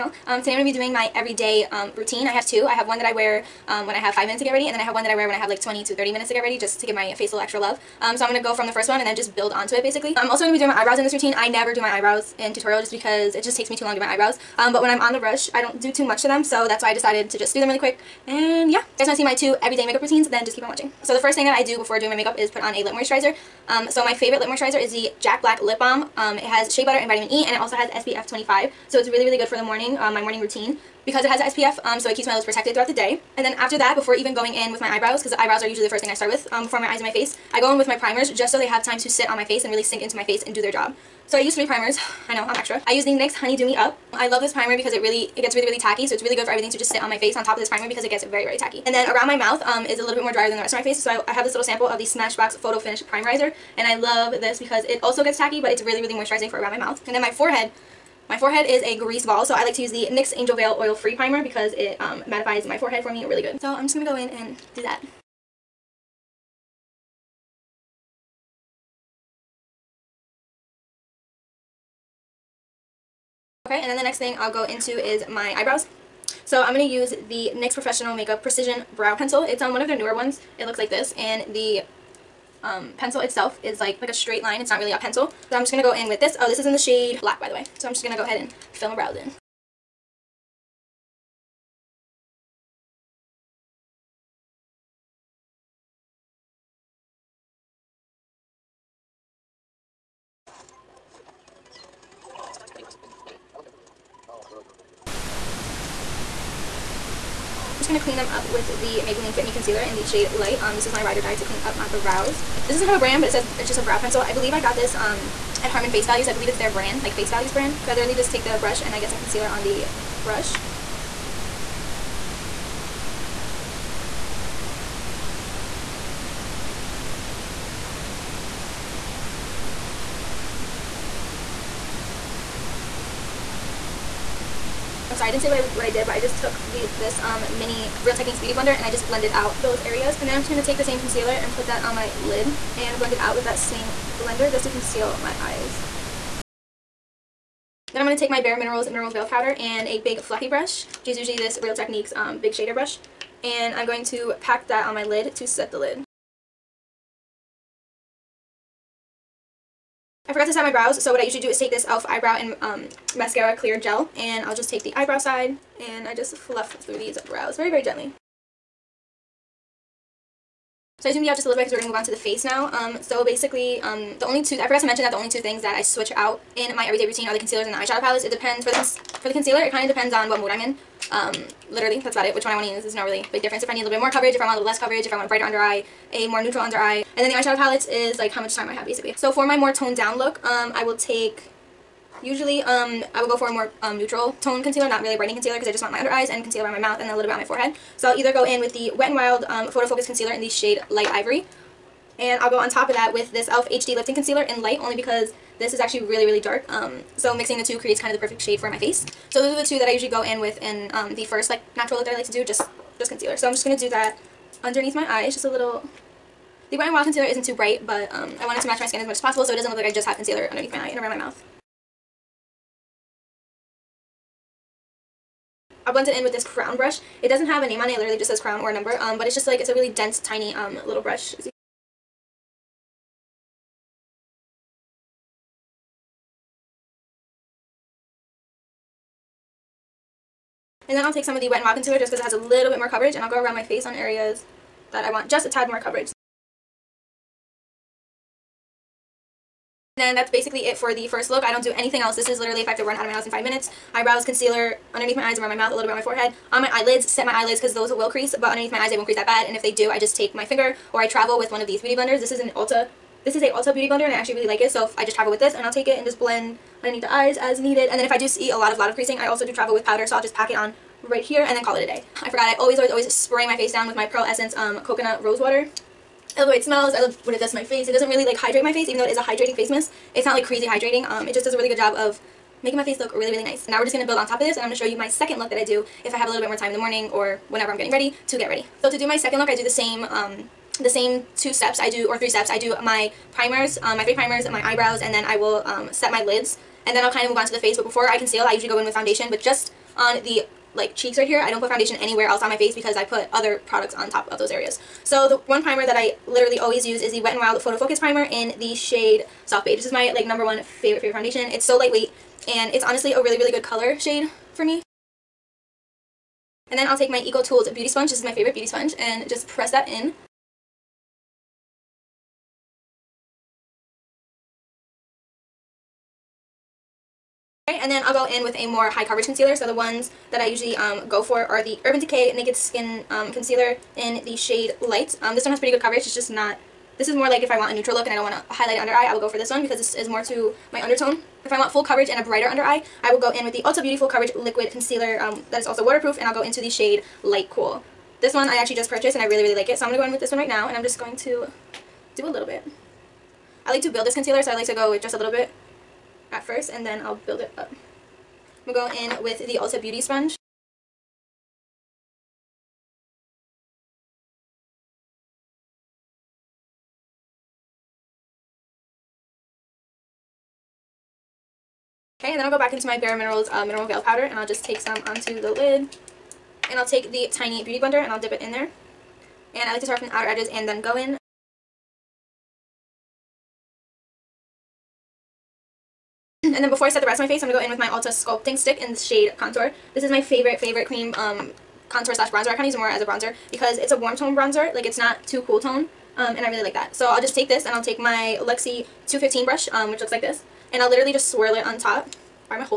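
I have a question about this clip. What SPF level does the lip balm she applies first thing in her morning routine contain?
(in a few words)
25.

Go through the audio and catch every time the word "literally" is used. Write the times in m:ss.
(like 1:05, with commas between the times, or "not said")
1:57, 3:01, 3:47, 4:12, 5:06, 6:40.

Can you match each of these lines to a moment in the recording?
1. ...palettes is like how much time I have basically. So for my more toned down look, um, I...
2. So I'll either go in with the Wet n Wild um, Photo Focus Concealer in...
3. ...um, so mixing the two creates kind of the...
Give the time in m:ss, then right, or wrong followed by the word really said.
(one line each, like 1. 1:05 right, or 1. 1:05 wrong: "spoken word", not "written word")
1. 3:07 right
2. 3:17 right
3. 3:26 right.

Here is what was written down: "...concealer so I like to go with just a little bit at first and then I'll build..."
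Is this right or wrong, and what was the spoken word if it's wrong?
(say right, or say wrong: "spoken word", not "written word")
right.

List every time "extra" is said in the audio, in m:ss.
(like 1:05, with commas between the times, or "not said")
0:07, 0:42.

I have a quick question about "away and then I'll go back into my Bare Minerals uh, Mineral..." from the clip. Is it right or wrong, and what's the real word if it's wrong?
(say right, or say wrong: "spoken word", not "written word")
right.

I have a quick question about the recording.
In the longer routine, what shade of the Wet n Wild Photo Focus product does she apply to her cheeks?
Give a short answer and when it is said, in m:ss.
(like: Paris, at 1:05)
Soft Beige, at 5:09.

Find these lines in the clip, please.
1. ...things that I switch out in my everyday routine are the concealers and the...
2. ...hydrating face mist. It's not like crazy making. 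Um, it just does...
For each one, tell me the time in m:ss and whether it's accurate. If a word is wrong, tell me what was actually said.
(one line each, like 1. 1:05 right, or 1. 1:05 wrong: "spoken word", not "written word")
1. 2:55 right
2. 4:39 wrong: "hydrating", not "making".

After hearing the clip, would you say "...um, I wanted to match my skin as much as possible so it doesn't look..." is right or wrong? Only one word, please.
right.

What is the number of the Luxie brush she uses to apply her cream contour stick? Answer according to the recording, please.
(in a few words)
215.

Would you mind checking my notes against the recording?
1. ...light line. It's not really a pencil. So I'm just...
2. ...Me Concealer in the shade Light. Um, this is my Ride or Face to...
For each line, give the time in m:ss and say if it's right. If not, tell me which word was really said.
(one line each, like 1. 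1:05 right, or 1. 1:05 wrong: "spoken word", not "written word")
1. 1:24 wrong: "straight", not "light"
2. 1:49 wrong: "Die", not "Face".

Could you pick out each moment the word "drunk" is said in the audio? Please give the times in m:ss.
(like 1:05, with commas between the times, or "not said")
not said.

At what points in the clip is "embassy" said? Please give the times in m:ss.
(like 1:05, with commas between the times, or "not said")
not said.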